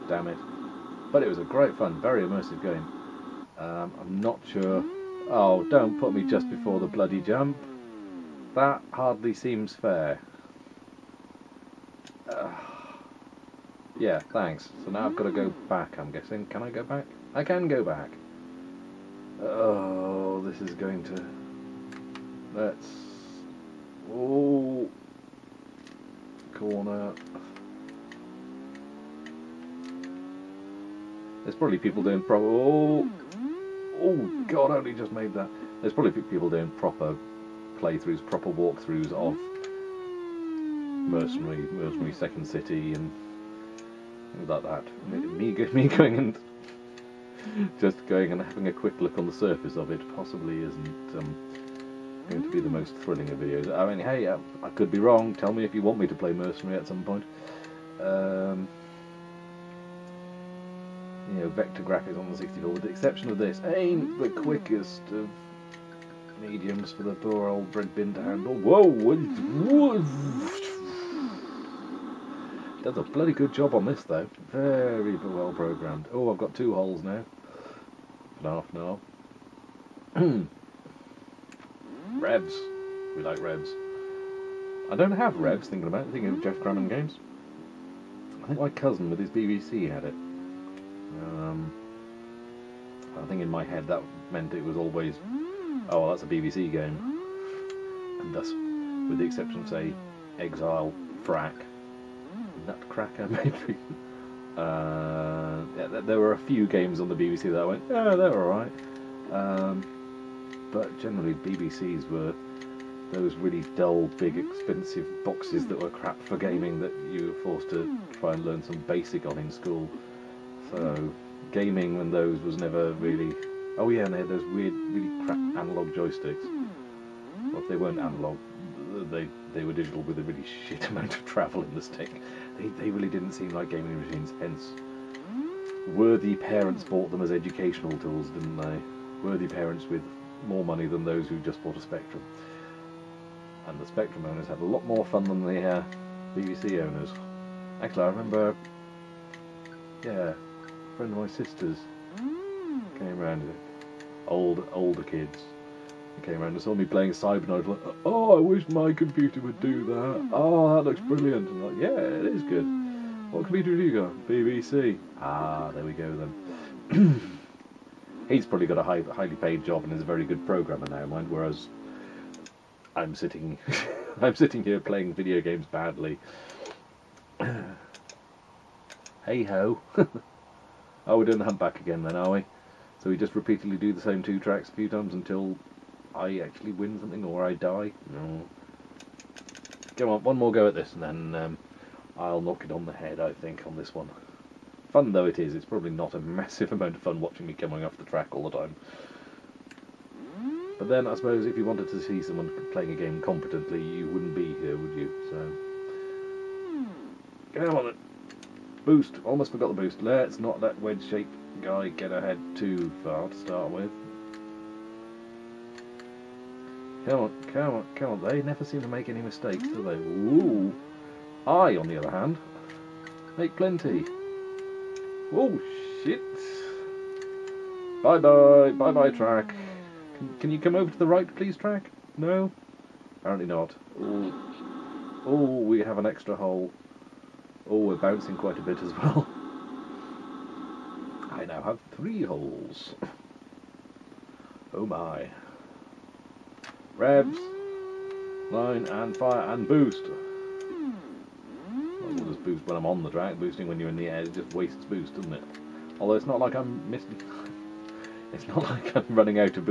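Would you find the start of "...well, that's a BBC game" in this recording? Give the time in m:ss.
1:36.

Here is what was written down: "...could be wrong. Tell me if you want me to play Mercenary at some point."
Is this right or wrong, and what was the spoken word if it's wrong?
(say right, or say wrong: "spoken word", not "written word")
right.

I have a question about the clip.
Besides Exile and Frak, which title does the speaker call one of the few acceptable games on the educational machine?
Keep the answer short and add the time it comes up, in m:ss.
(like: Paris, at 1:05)
Nutcracker, at 1:42.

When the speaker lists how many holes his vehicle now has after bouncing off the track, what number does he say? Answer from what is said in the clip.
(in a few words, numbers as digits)
3.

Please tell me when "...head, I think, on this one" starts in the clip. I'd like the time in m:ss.
3:12.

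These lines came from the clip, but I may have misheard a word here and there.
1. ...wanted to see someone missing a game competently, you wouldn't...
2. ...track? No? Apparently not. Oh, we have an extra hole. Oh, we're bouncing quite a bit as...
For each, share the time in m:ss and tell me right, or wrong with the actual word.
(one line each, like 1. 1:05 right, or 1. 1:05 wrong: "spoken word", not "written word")
1. 3:21 wrong: "playing", not "missing"
2. 3:51 right.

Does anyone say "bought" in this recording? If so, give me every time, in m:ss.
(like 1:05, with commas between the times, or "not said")
2:16, 2:21.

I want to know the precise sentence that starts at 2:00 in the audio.
So, gaming on those was never really Oh yeah, and they had those weird, really crap analog joysticks.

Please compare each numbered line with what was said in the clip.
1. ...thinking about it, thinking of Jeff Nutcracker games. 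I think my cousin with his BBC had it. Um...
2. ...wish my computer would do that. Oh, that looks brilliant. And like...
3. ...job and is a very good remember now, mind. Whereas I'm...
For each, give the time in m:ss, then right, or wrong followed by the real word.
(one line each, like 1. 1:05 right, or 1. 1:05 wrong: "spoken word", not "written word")
1. 1:25 wrong: "Grammon", not "Nutcracker"
2. 2:38 right
3. 2:49 wrong: "programmer", not "remember".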